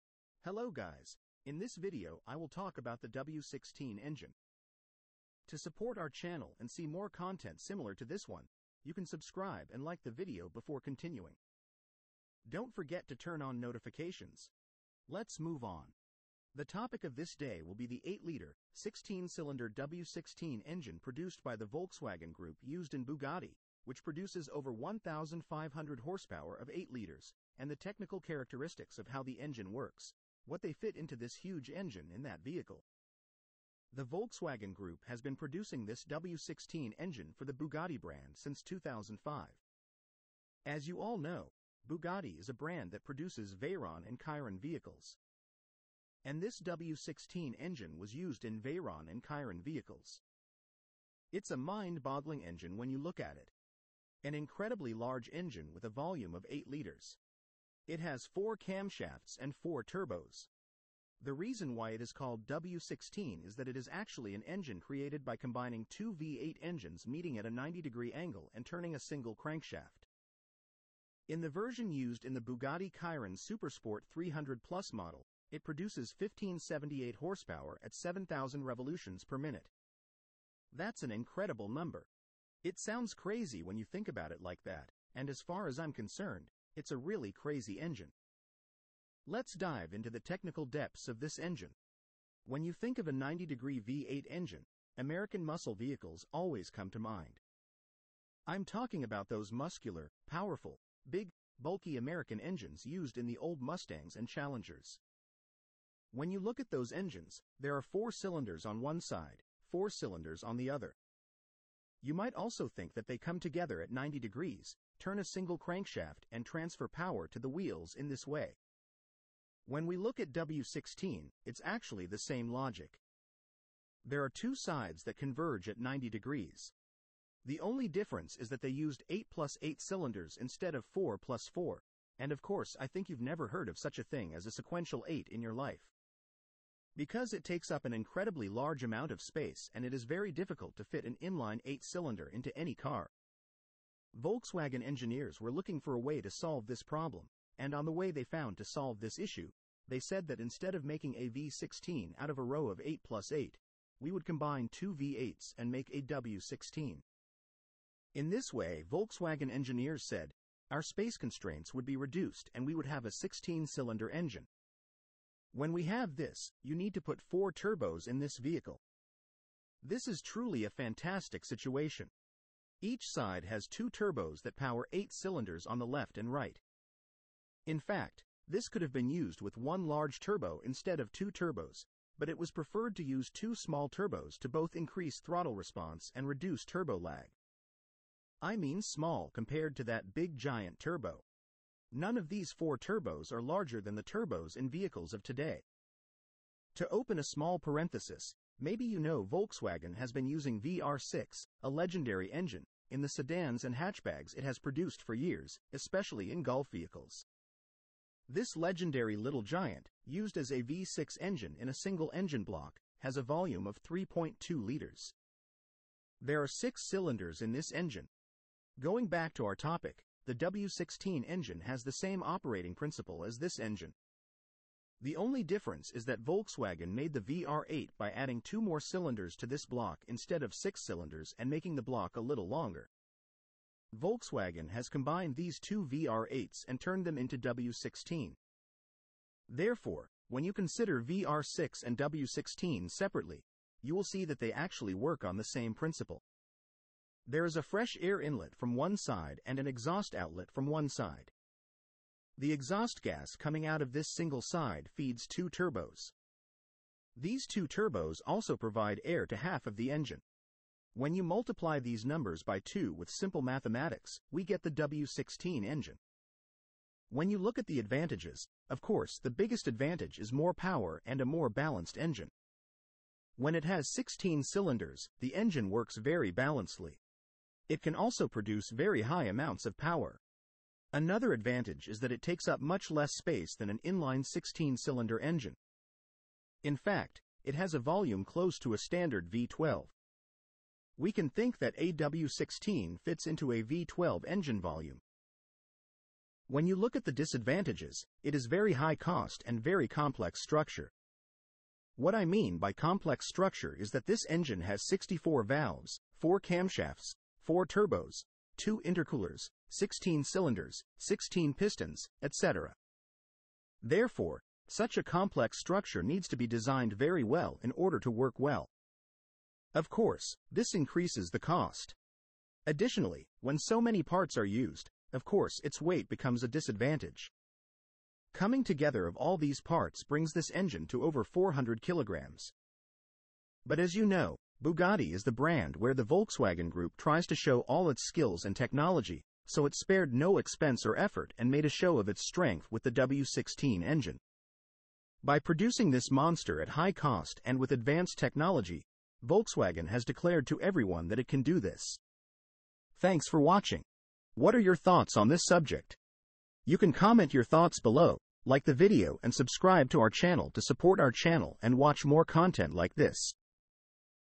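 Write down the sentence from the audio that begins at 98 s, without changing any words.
I'm talking about those muscular, powerful, big, bulky American engines used in the old Mustangs and Challengers.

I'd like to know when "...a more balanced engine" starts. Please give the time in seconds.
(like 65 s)
271 s.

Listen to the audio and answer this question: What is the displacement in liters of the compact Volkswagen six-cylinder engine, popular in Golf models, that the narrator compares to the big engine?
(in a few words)
3.2 liters.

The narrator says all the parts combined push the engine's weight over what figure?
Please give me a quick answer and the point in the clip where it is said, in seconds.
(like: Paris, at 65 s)
400 kilograms, at 331 s.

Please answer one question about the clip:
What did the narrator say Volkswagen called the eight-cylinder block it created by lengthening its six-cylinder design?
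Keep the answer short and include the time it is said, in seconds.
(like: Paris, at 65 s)
VR8, at 227 s.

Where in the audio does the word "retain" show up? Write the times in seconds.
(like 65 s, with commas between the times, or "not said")
not said.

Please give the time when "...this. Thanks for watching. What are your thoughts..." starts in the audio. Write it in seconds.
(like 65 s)
351 s.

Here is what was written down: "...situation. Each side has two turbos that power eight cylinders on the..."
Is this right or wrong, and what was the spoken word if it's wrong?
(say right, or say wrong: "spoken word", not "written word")
right.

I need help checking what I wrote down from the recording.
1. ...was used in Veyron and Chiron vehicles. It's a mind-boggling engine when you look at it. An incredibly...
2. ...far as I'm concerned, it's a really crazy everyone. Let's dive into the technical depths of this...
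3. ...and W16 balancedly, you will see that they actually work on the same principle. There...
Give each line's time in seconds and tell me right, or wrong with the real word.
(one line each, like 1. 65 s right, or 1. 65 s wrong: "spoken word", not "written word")
1. 47 s right
2. 85 s wrong: "engine", not "everyone"
3. 241 s wrong: "separately", not "balancedly".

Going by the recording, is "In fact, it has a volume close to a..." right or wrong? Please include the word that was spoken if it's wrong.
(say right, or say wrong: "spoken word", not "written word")
right.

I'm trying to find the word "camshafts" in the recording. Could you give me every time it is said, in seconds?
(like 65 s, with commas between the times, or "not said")
58 s, 306 s.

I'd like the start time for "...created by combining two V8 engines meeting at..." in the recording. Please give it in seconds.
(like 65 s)
64 s.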